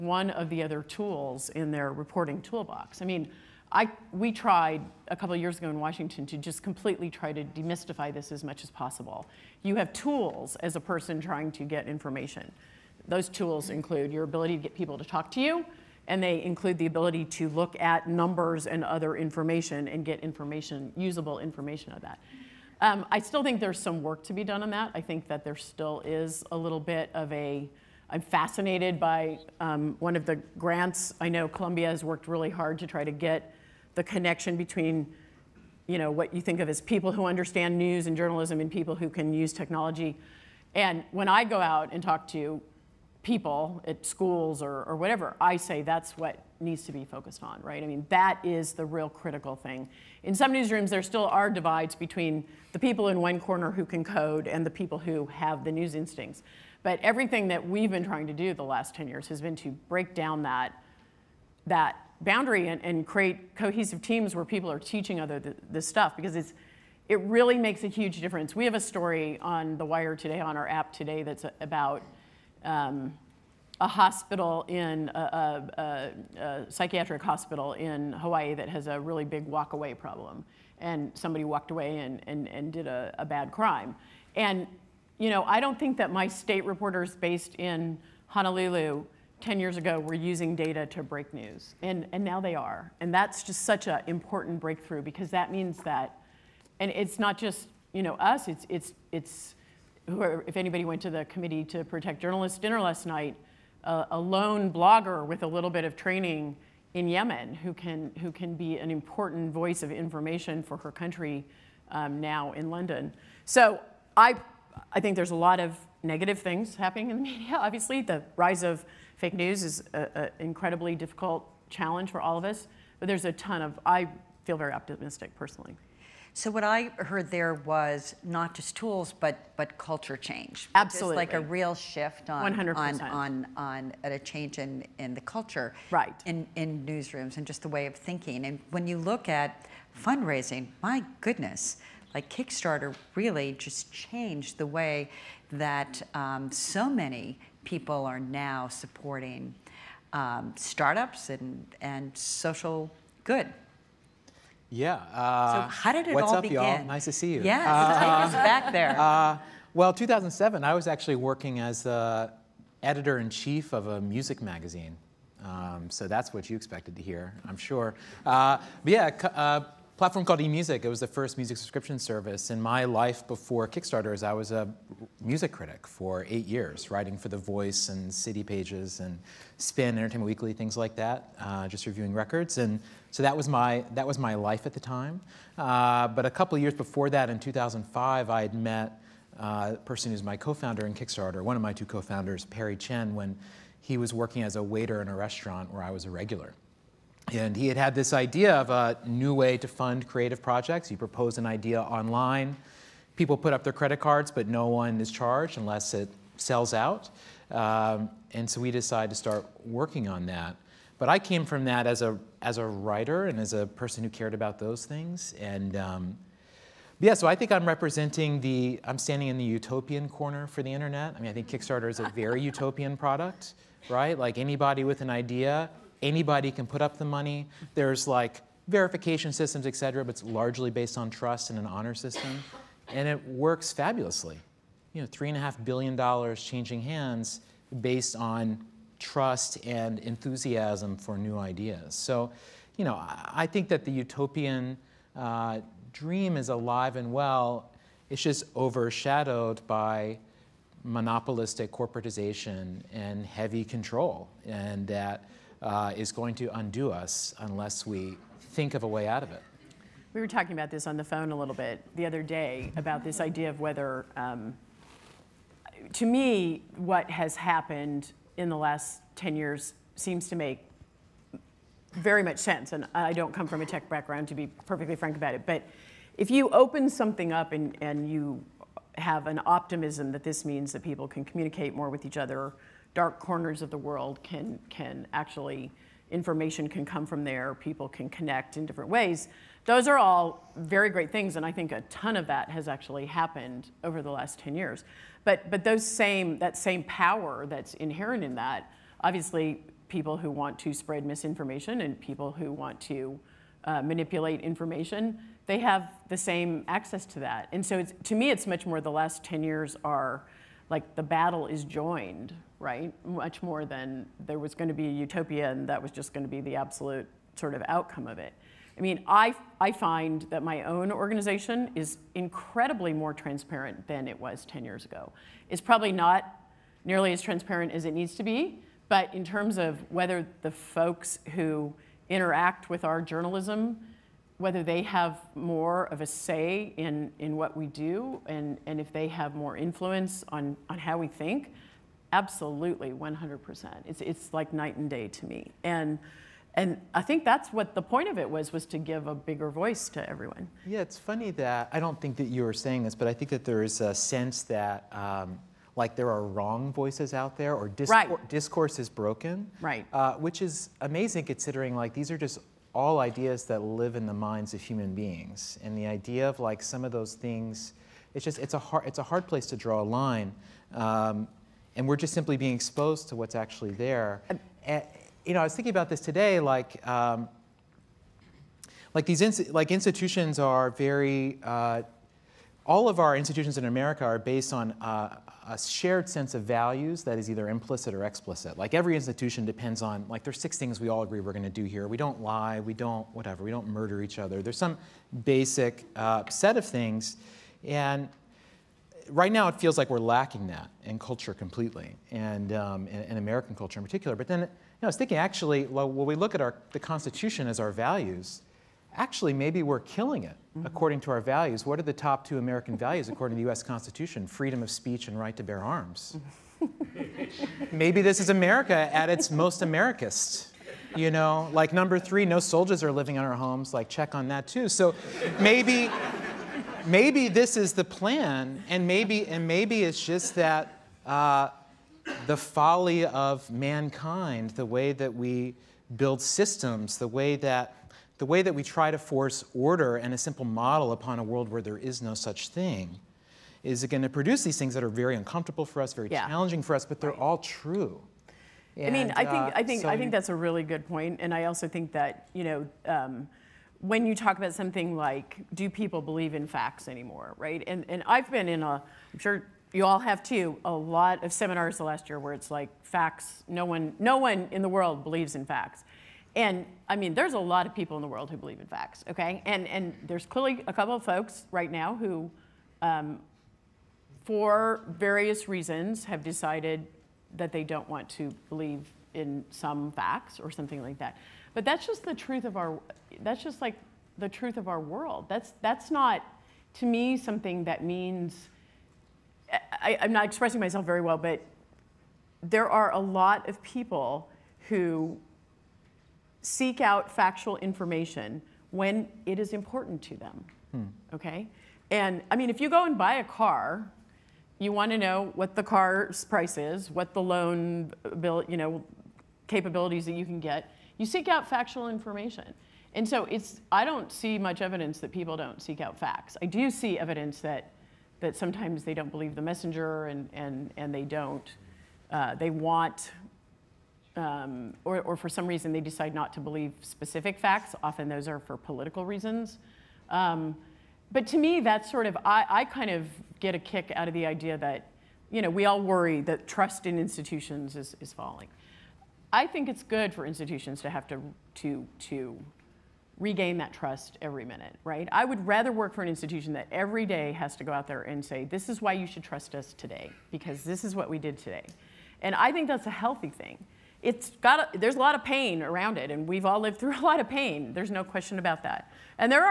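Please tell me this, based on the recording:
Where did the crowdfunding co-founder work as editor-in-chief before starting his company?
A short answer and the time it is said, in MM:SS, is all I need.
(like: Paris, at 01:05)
eMusic, at 02:50.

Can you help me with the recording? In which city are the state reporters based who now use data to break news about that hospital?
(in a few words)
Honolulu.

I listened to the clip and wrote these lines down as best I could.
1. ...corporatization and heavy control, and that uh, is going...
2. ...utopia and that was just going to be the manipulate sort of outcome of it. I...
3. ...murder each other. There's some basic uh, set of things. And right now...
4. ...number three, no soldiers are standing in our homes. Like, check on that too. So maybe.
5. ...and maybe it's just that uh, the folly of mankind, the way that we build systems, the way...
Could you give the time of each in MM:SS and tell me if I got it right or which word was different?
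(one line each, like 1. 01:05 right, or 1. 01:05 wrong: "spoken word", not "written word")
1. 04:11 right
2. 05:14 wrong: "absolute", not "manipulate"
3. 06:33 right
4. 07:01 wrong: "living", not "standing"
5. 07:09 right.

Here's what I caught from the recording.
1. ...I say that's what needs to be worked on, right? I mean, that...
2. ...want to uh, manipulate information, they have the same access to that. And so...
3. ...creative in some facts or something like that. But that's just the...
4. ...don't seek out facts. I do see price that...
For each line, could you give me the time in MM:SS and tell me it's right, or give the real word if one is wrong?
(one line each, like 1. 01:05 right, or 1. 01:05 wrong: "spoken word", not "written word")
1. 00:45 wrong: "focused", not "worked"
2. 05:02 right
3. 07:58 wrong: "believe", not "creative"
4. 08:35 wrong: "evidence", not "price".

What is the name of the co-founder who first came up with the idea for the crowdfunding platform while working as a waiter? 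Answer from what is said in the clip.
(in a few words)
Perry Chen.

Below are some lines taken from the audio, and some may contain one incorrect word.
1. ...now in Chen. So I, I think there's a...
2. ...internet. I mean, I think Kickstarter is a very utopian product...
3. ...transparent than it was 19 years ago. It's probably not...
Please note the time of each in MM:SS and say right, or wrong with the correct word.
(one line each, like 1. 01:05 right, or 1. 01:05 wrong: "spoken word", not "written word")
1. 01:52 wrong: "London", not "Chen"
2. 03:40 right
3. 05:23 wrong: "10", not "19".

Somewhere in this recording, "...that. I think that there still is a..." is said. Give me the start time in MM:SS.
00:24.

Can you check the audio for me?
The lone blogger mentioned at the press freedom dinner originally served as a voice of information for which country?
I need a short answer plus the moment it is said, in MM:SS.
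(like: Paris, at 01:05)
Yemen, at 01:47.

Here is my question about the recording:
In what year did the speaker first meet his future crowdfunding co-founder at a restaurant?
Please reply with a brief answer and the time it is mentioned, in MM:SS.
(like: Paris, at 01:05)
2005, at 03:07.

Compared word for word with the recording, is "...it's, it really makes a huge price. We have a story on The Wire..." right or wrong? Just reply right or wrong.
wrong.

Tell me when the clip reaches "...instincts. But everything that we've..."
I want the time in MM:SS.
00:55.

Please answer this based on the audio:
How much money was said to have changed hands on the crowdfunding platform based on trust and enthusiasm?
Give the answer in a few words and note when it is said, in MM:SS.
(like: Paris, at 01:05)
3.5 billion dollars, at 03:55.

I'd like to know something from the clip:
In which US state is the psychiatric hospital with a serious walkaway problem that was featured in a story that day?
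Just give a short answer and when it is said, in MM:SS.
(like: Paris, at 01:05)
Hawaii, at 01:18.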